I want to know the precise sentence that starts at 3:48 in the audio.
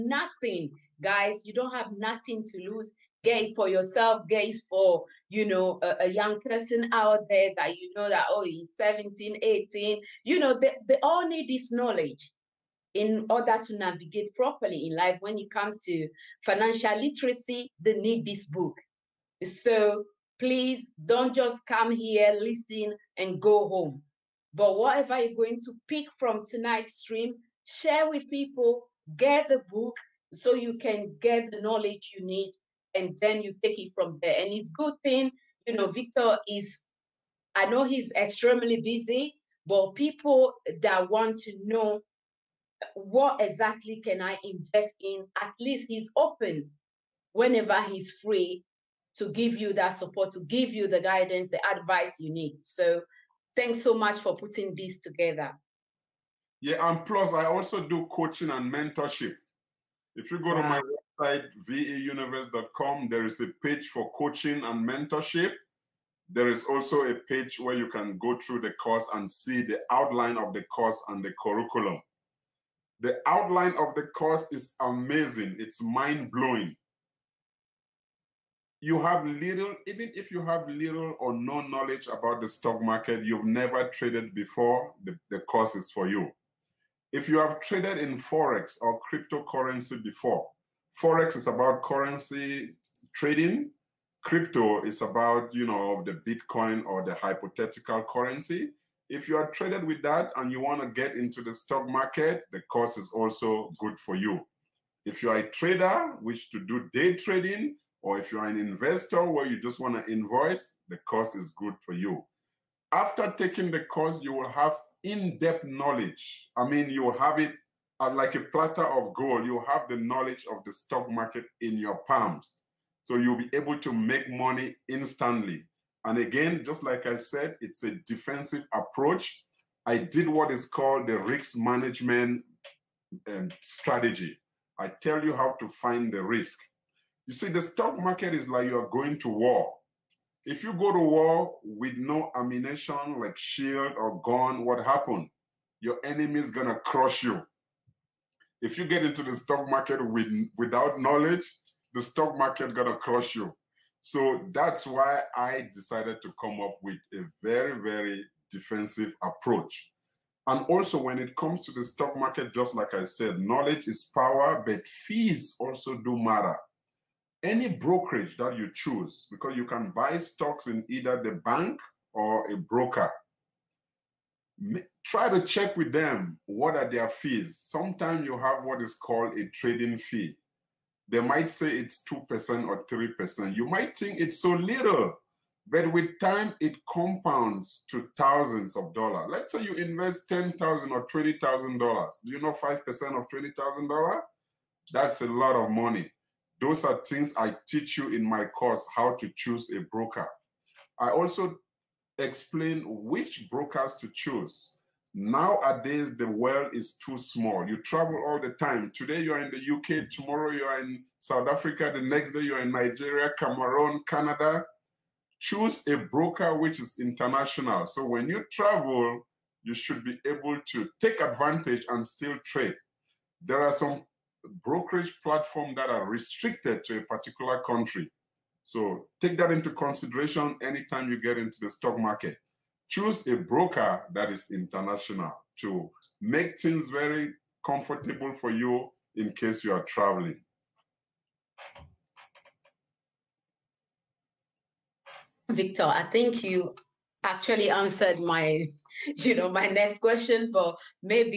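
So take that into consideration anytime you get into the stock market.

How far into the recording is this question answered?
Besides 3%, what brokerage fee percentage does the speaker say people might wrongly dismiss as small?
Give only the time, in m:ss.
3:02.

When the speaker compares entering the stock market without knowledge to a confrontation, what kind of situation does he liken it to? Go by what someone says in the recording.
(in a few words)
going to war.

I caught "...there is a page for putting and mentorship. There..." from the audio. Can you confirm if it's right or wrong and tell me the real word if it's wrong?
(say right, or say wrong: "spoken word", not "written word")
wrong: "coaching", not "putting".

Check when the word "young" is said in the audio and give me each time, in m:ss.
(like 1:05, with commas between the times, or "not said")
0:06.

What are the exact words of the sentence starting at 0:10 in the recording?
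You know, they, they all need this knowledge in order to navigate properly in life.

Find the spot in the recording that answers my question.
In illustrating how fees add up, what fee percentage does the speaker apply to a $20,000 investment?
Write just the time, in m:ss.
3:12.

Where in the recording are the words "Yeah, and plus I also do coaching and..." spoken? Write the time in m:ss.
0:56.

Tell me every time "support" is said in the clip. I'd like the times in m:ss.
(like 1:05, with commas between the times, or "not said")
0:49.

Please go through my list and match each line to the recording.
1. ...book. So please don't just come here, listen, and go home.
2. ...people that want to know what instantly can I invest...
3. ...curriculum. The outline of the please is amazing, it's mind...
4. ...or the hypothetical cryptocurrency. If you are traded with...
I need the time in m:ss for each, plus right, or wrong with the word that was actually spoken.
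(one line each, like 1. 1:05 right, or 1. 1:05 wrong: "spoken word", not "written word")
1. 0:18 right
2. 0:39 wrong: "exactly", not "instantly"
3. 1:11 wrong: "course", not "please"
4. 1:36 wrong: "currency", not "cryptocurrency".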